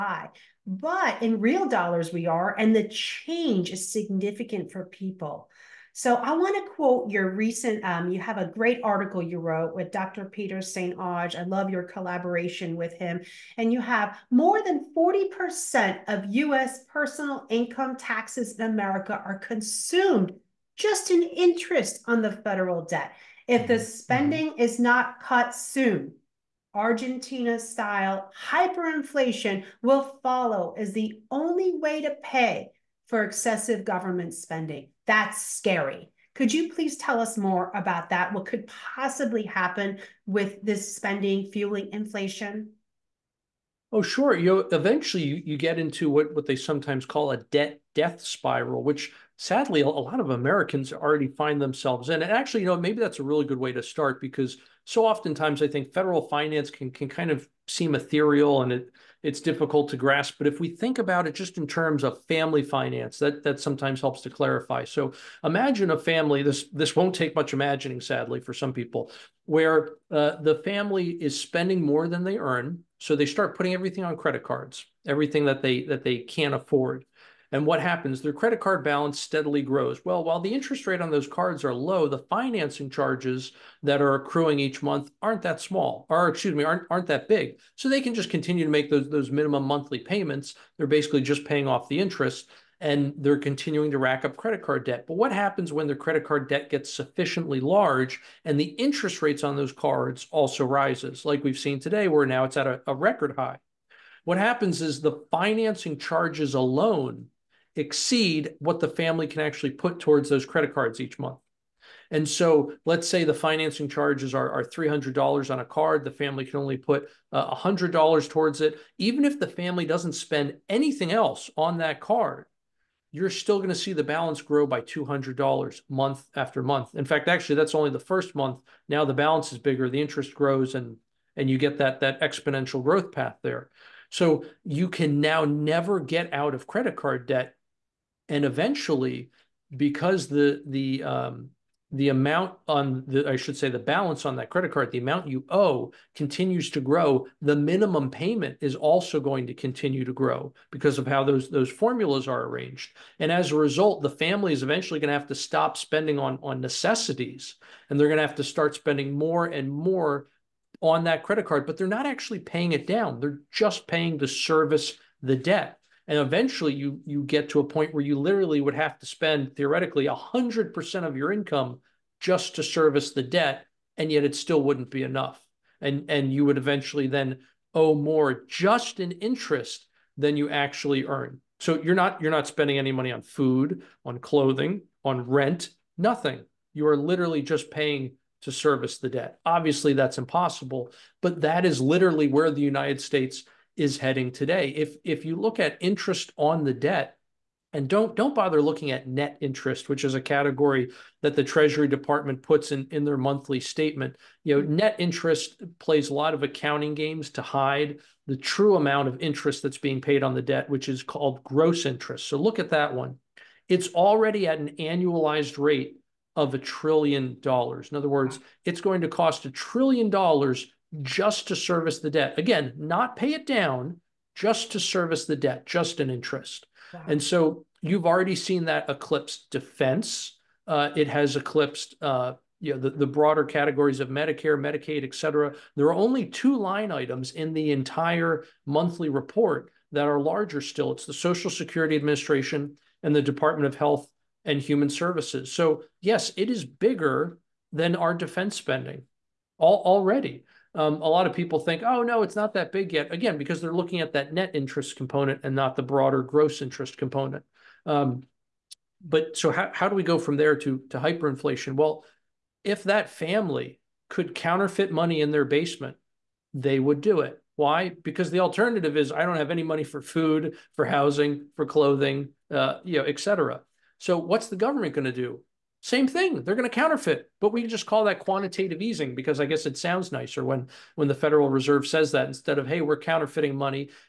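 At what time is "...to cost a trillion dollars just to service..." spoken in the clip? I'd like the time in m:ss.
3:39.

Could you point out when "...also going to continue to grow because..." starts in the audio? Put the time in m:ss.
2:28.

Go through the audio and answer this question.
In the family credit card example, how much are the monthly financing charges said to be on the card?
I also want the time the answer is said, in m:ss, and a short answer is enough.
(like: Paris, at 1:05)
$300, at 1:54.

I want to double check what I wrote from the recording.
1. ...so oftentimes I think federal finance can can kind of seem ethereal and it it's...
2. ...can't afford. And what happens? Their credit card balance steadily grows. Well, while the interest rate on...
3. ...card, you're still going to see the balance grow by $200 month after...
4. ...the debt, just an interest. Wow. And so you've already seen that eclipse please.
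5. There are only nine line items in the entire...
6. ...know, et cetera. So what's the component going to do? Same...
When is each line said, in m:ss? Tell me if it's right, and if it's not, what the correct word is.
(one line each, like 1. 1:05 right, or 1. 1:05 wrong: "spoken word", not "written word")
1. 0:54 right
2. 1:16 right
3. 2:02 right
4. 3:45 wrong: "defense", not "please"
5. 3:55 wrong: "two", not "nine"
6. 4:32 wrong: "government", not "component".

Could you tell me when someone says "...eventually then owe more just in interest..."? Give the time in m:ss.
2:56.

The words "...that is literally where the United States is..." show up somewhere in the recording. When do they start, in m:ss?
3:11.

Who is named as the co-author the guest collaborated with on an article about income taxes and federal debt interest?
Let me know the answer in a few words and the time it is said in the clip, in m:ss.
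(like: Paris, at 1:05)
Dr. Peter St. Onge, at 0:09.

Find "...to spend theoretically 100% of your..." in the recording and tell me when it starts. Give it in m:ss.
2:48.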